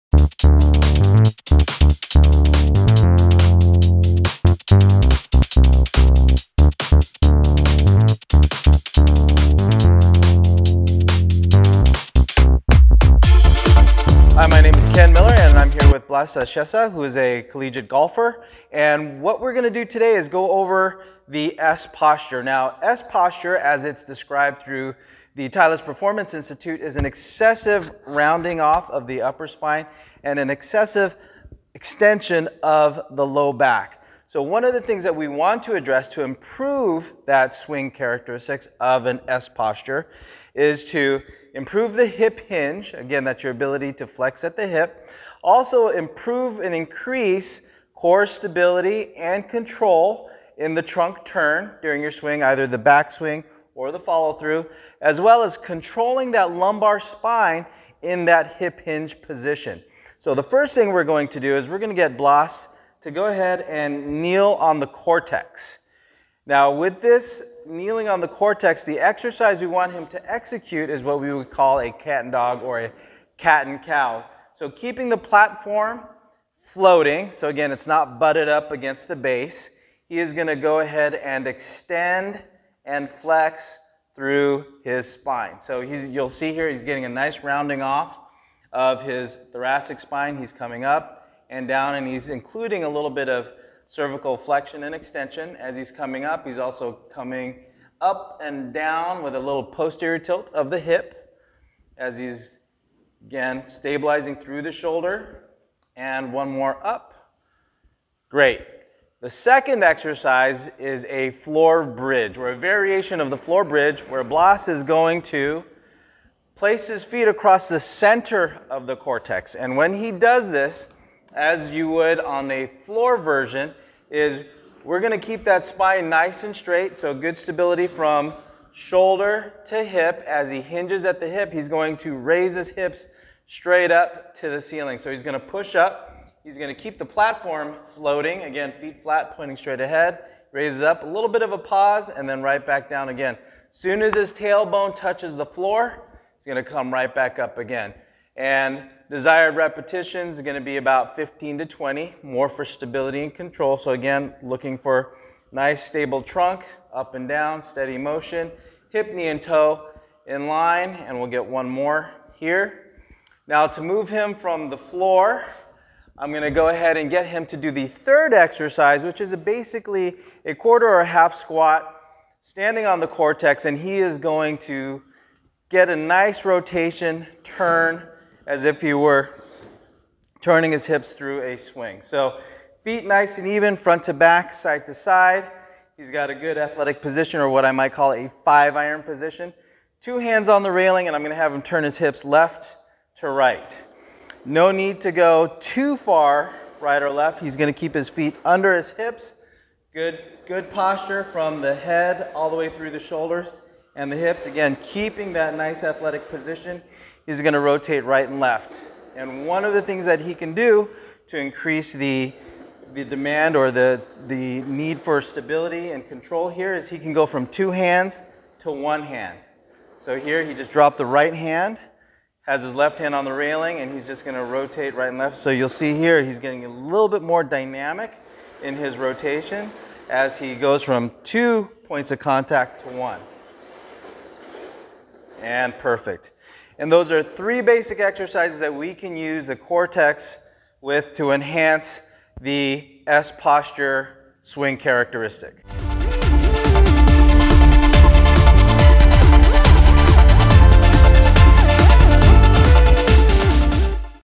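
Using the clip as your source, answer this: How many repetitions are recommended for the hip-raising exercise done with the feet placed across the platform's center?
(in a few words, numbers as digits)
15 to 20.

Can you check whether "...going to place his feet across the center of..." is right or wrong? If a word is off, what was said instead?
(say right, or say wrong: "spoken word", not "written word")
right.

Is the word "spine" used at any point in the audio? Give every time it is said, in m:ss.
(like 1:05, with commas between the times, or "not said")
0:29, 0:56, 1:25, 1:29, 2:05.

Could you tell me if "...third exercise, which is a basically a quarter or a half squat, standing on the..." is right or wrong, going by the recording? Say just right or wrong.
right.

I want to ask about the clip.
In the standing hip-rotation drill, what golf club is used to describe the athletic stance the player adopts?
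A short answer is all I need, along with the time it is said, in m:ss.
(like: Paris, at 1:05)
five iron, at 3:08.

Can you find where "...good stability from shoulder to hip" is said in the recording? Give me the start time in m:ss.
2:07.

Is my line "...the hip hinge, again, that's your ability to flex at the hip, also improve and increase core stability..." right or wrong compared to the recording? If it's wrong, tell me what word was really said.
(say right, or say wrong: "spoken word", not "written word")
right.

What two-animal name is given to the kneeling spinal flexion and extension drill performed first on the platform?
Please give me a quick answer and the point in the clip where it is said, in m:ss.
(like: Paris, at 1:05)
cat and cow, at 1:13.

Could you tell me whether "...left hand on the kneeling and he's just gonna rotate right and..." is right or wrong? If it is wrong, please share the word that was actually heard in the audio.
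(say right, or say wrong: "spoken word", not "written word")
wrong: "railing", not "kneeling".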